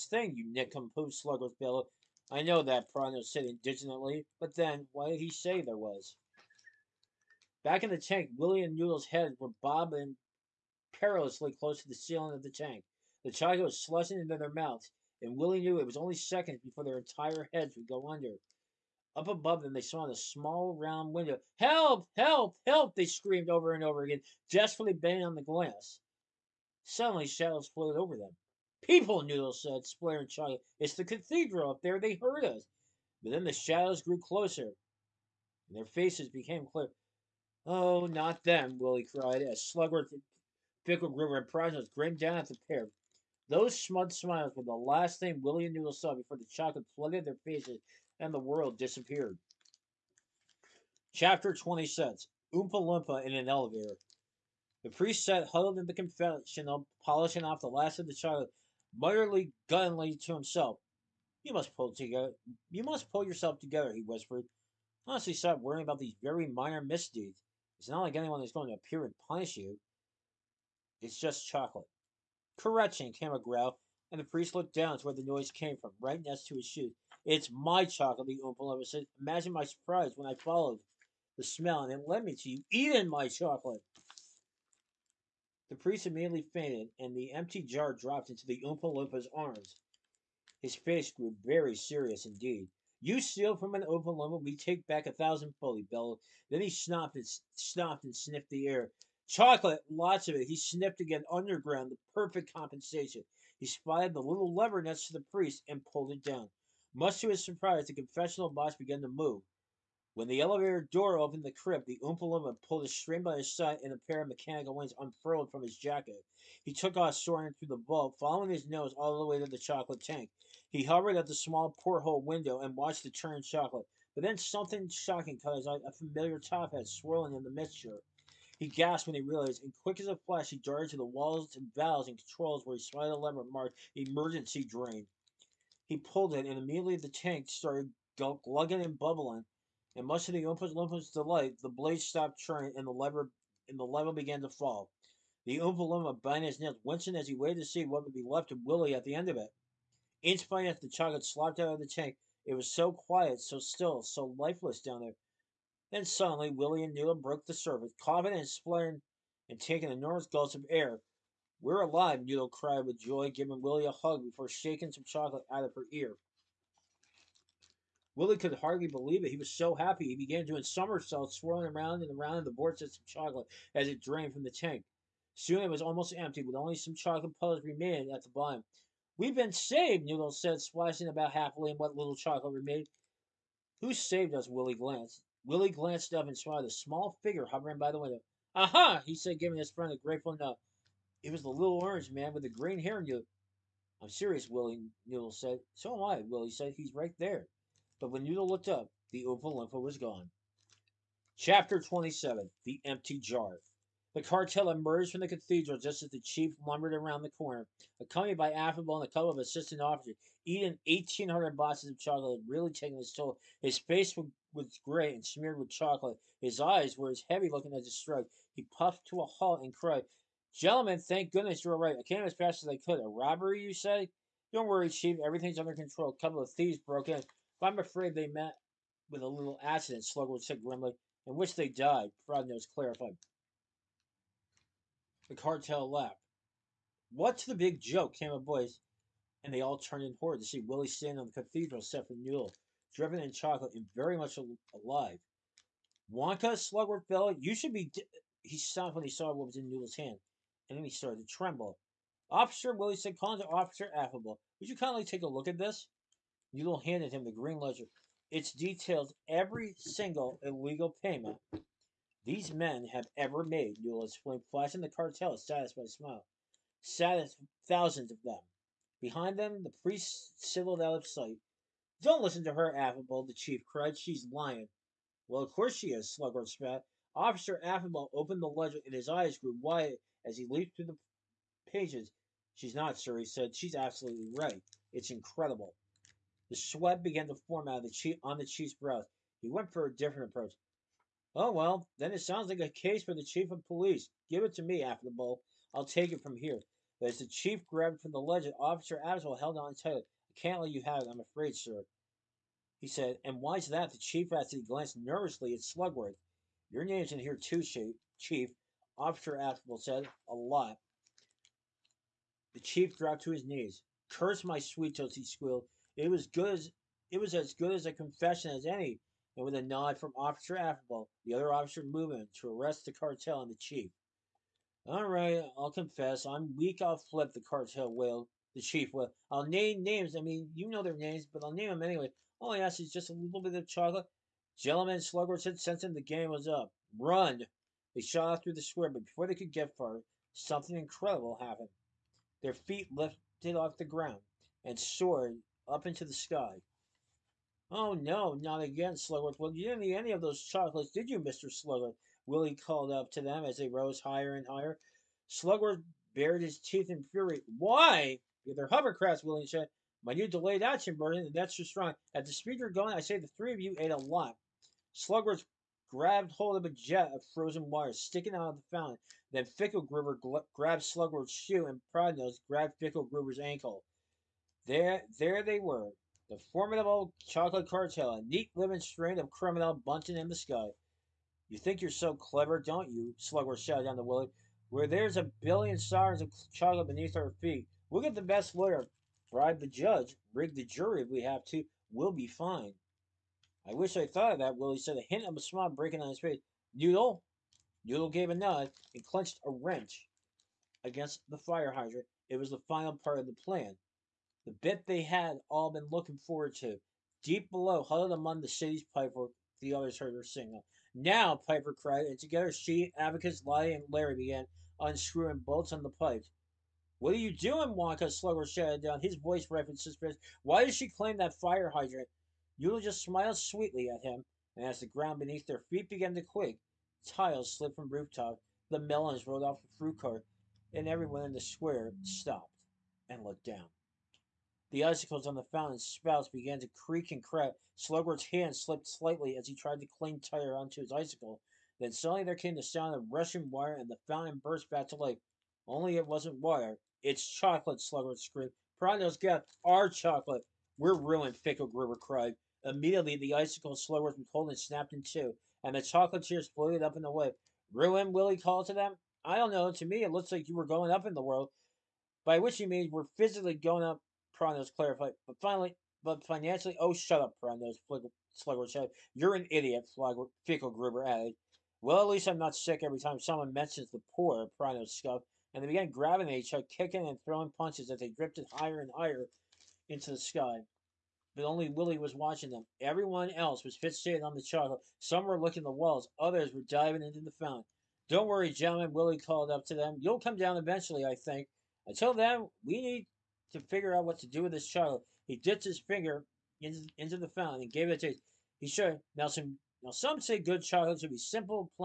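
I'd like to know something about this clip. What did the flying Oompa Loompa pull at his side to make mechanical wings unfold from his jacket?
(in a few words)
a string.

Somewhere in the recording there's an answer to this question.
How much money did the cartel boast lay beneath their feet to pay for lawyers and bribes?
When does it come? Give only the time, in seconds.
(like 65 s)
385 s.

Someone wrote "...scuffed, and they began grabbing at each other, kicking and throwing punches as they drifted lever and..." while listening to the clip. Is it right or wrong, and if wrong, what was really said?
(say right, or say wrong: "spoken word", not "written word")
wrong: "higher", not "lever".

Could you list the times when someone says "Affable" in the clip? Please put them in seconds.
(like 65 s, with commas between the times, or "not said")
208 s, 253 s, 272 s, 277 s, 299 s, 309 s, 320 s.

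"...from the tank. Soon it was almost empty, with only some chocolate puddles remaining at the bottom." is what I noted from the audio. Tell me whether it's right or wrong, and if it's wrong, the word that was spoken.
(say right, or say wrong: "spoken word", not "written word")
right.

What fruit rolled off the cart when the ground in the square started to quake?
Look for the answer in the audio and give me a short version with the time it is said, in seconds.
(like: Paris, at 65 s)
melons, at 428 s.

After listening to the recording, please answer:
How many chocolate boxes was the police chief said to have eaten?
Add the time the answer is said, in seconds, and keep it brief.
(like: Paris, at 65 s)
1,800, at 210 s.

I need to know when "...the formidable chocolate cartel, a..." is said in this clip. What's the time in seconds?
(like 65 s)
376 s.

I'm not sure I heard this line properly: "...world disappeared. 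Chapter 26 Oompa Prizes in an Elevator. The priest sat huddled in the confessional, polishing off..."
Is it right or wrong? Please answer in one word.
wrong.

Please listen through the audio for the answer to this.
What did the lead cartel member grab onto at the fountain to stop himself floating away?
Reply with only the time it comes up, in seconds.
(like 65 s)
366 s.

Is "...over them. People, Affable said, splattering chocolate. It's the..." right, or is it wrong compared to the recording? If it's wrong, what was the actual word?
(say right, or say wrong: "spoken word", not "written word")
wrong: "Noodle", not "Affable".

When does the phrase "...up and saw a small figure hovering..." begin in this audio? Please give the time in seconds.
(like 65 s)
186 s.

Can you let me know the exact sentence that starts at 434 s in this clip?
The icicles on the fountain's spouts began to creak and crack.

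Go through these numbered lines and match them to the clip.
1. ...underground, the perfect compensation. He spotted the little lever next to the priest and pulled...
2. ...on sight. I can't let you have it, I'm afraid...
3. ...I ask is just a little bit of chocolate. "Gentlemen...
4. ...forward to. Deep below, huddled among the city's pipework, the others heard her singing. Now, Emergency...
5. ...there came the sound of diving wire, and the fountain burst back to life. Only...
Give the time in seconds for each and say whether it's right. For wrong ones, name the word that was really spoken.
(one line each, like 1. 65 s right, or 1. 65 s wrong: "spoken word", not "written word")
1. 101 s right
2. 299 s wrong: "tight", not "sight"
3. 332 s right
4. 406 s wrong: "Piper", not "Emergency"
5. 442 s wrong: "rushing", not "diving".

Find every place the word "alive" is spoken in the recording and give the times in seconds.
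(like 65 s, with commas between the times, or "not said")
161 s, 244 s.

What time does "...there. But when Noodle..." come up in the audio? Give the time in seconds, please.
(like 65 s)
197 s.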